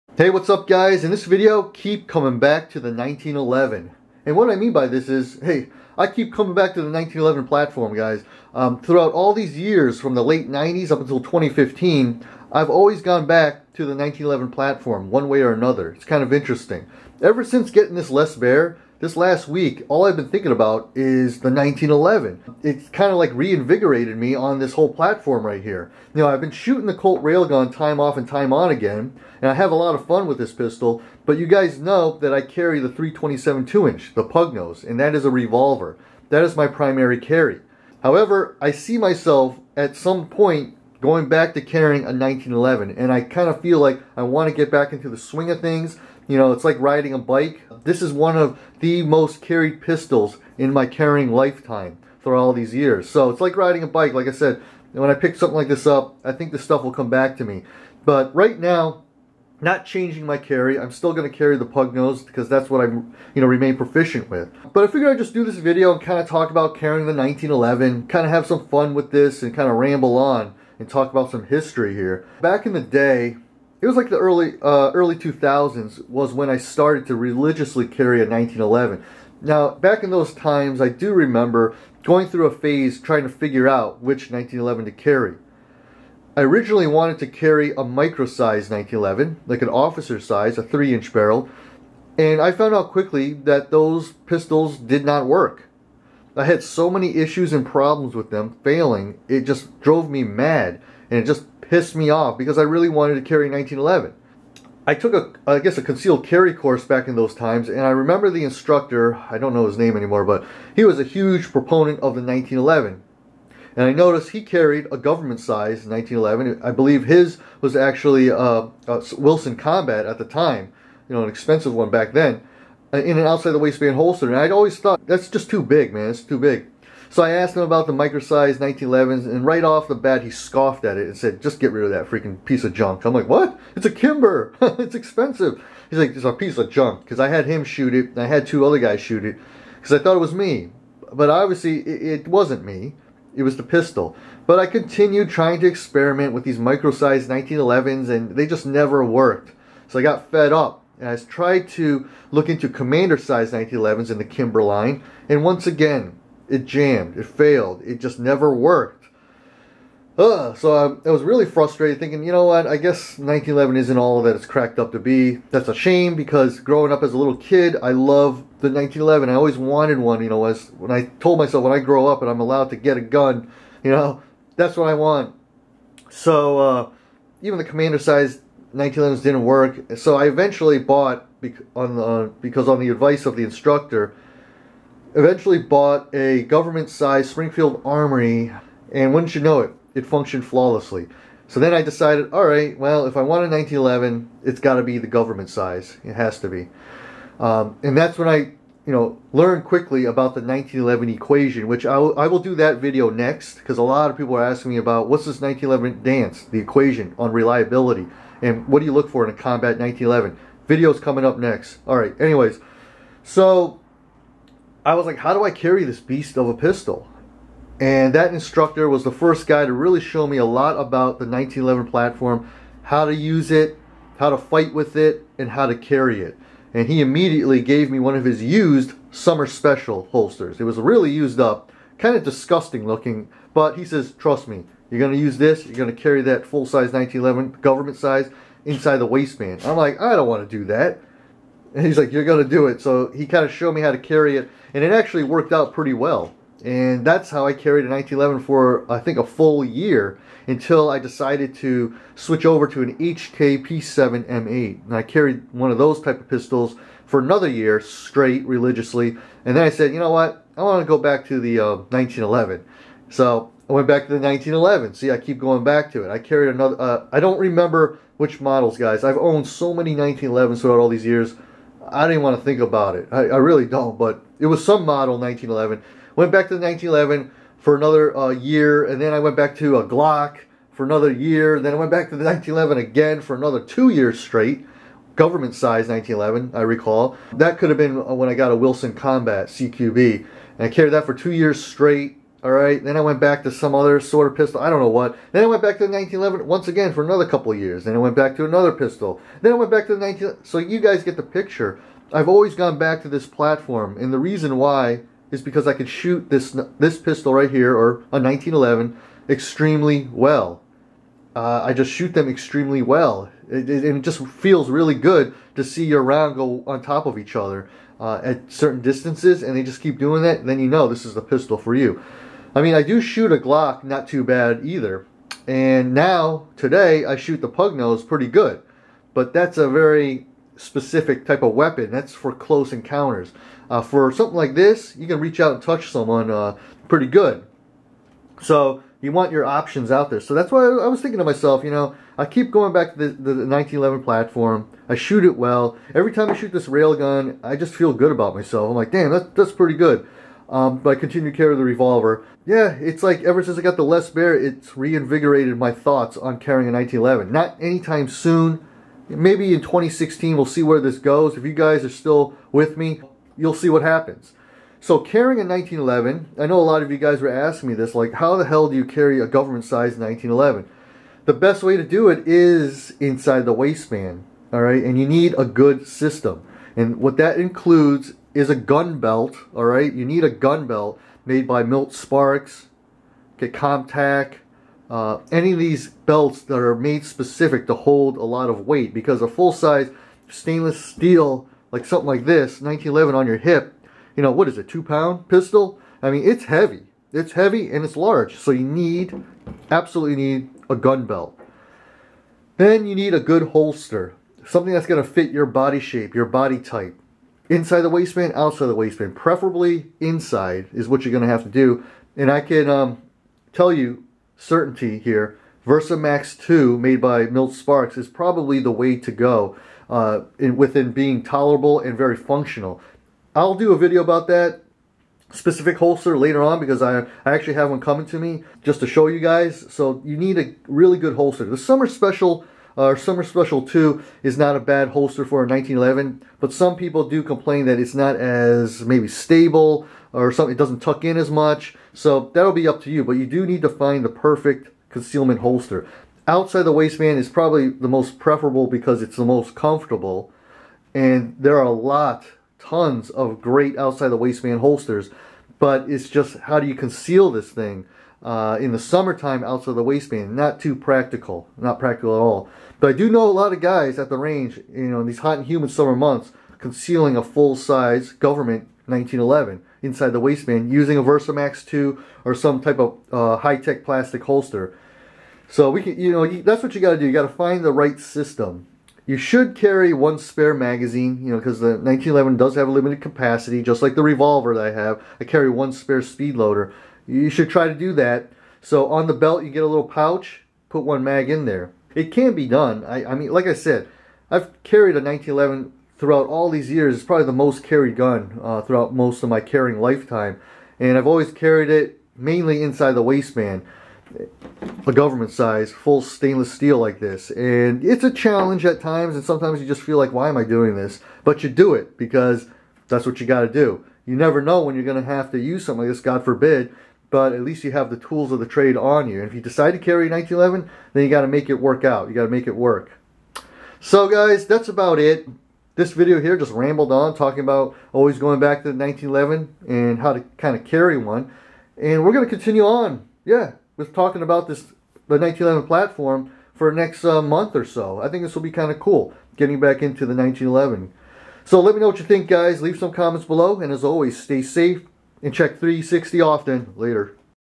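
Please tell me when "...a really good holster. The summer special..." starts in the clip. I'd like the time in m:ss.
7:10.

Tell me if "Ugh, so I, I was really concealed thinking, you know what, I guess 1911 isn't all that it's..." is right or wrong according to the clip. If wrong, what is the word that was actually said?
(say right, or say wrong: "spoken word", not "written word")
wrong: "frustrated", not "concealed".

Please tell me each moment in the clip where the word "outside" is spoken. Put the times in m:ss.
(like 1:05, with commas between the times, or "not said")
2:03, 6:48, 7:26, 7:33, 7:39.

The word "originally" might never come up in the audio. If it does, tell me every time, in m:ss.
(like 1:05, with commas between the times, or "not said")
1:26.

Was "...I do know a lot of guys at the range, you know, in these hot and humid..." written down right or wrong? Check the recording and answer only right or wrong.
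right.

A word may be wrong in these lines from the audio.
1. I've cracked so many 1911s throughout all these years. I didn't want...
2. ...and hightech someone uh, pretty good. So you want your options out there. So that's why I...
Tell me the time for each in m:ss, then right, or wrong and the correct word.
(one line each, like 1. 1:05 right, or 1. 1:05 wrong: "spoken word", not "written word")
1. 4:29 wrong: "owned", not "cracked"
2. 5:35 wrong: "touch", not "hightech".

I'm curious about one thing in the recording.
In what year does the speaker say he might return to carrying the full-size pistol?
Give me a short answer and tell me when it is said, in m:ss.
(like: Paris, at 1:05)
2016, at 5:59.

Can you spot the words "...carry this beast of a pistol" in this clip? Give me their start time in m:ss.
3:35.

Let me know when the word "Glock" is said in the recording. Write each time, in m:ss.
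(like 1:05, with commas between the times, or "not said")
4:39, 5:23.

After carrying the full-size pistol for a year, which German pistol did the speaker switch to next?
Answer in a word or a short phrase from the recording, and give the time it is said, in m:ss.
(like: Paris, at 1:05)
HKP7 M8, at 4:12.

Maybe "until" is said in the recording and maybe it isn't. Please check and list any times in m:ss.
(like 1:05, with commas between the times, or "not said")
0:11, 4:10.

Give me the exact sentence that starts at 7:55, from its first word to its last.
So we can, you know, that's what you got to do.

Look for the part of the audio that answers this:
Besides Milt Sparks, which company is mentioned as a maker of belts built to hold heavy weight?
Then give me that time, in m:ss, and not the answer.
6:23.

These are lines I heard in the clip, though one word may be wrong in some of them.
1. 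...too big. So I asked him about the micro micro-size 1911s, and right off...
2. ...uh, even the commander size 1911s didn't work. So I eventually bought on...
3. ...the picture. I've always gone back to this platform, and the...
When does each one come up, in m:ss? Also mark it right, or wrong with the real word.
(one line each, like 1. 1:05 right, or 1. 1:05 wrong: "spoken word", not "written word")
1. 2:06 right
2. 2:56 right
3. 5:01 right.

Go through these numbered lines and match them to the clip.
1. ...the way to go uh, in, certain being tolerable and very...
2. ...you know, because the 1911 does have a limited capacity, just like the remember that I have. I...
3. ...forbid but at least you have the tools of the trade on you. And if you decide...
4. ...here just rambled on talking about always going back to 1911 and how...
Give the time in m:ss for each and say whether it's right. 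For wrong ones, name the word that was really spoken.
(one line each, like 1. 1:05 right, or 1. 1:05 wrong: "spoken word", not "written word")
1. 6:58 wrong: "within", not "certain"
2. 8:01 wrong: "revolver", not "remember"
3. 8:36 right
4. 8:46 right.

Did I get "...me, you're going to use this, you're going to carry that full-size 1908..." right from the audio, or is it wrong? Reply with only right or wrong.
wrong.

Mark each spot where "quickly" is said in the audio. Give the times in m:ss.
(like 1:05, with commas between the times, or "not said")
1:32, 3:19.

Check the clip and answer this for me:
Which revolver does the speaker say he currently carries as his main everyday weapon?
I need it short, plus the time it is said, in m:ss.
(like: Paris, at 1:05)
327 2-inch, at 0:32.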